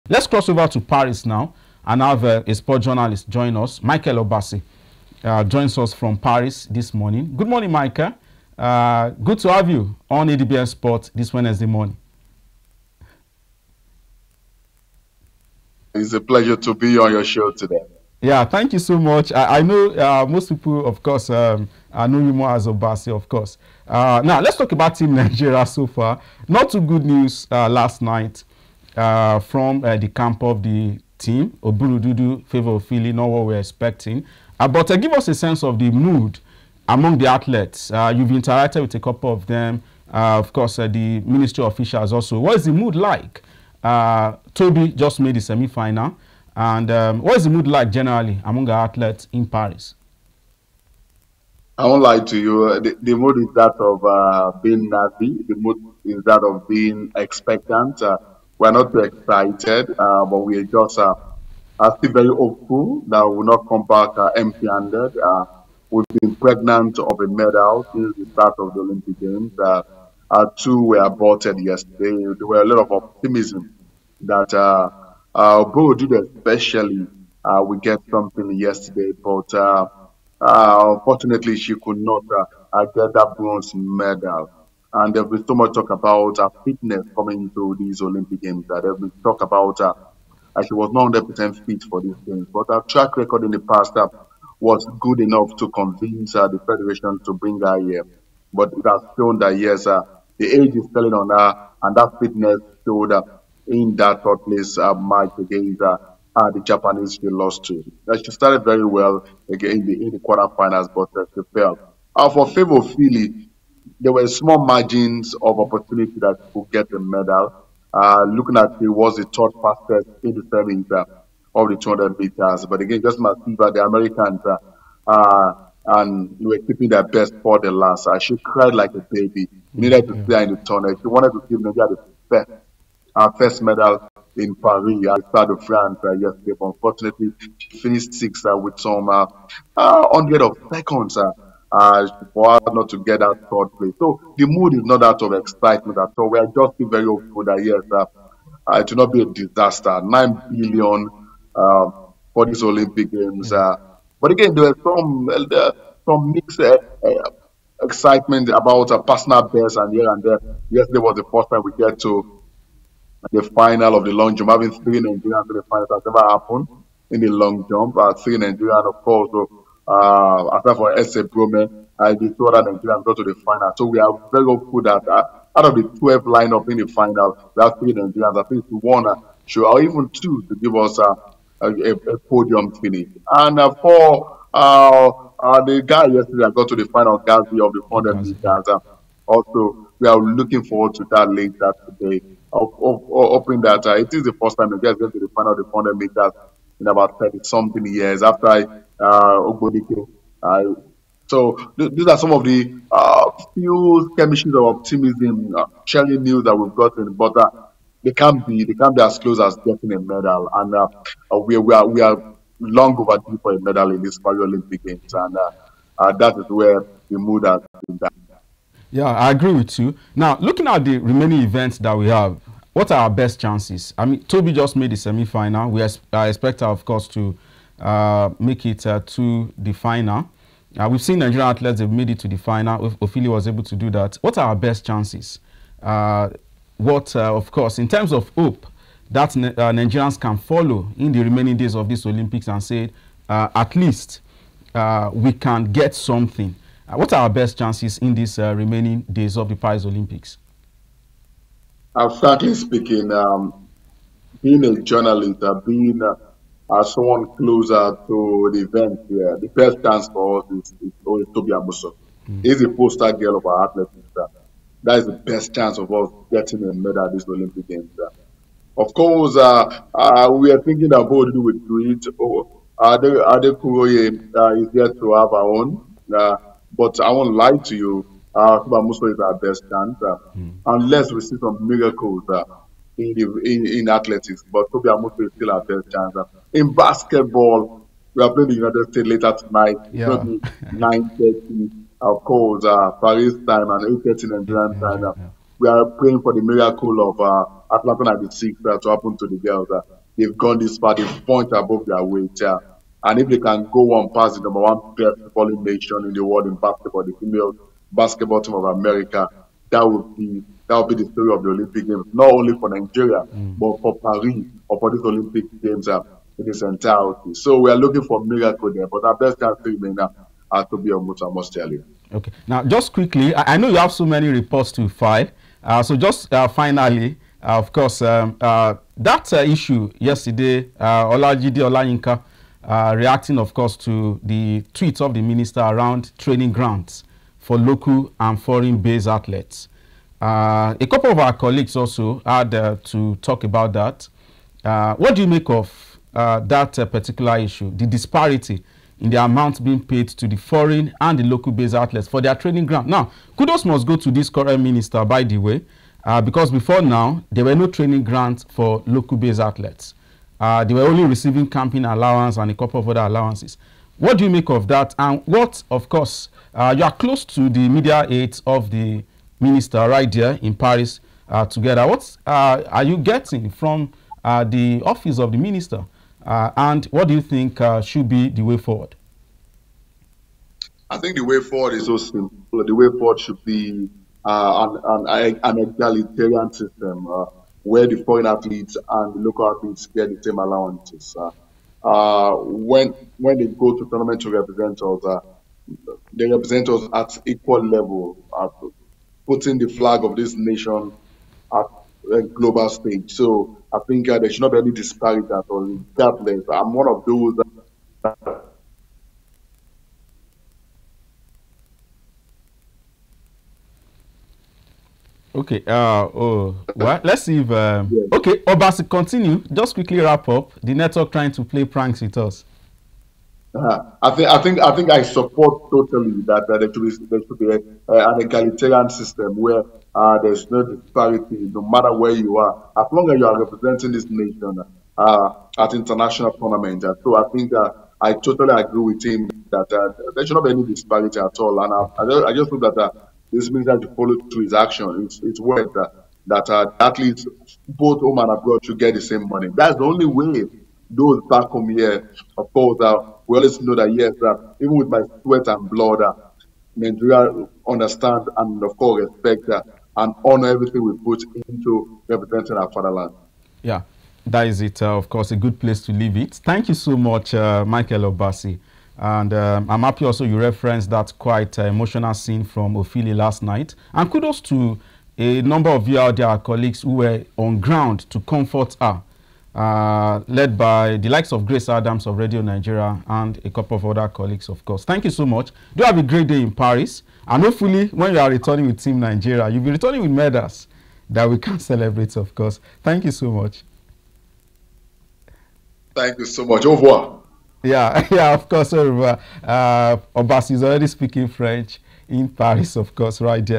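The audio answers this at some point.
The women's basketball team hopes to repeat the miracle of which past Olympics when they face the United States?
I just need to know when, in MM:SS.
04:57.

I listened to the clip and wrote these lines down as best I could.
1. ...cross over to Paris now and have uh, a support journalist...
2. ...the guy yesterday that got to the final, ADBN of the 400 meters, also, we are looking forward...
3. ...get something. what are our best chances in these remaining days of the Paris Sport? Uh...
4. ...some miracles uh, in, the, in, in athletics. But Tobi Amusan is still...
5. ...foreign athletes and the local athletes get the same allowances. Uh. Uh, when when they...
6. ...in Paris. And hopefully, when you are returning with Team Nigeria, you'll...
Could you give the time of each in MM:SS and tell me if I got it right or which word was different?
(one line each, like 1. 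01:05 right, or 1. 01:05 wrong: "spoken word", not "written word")
1. 00:00 wrong: "sport", not "support"
2. 03:05 wrong: "Gazi", not "ADBN"
3. 04:05 wrong: "Olympics", not "Sport"
4. 04:41 right
5. 06:28 right
6. 08:06 right.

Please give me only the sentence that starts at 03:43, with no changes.
I mean, Tobi just made the semi-final.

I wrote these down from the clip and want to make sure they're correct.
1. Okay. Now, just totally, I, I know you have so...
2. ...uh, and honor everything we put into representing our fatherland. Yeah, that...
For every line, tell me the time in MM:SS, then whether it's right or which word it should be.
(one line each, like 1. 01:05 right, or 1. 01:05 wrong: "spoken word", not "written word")
1. 05:22 wrong: "quickly", not "totally"
2. 07:39 right.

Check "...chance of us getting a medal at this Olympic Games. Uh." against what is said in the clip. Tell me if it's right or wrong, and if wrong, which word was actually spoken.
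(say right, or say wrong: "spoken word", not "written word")
right.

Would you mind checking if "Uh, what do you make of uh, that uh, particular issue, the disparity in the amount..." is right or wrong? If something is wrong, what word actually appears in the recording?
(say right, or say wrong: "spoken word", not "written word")
right.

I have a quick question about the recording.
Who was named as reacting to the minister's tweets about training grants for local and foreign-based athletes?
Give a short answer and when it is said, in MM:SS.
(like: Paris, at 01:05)
Olajide Olayinka, at 05:31.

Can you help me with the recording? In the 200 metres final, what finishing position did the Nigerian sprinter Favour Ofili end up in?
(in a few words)
sixth.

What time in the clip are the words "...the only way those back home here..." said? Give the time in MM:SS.
07:29.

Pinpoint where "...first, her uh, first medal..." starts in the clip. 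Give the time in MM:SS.
02:12.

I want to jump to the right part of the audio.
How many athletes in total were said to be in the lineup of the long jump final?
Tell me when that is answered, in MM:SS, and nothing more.
02:55.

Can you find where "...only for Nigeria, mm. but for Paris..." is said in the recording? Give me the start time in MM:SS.
05:12.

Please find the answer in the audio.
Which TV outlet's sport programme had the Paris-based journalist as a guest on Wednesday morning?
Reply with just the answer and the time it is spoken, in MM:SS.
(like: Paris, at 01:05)
ADBN Sport, at 00:10.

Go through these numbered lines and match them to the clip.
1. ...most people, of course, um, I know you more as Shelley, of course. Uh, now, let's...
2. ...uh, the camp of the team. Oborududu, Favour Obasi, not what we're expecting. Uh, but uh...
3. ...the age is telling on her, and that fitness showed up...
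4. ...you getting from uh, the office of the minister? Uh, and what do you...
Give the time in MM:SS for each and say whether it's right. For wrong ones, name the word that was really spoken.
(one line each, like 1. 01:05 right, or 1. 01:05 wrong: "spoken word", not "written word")
1. 00:20 wrong: "Obasi", not "Shelley"
2. 00:29 wrong: "Ofili", not "Obasi"
3. 01:40 right
4. 06:12 right.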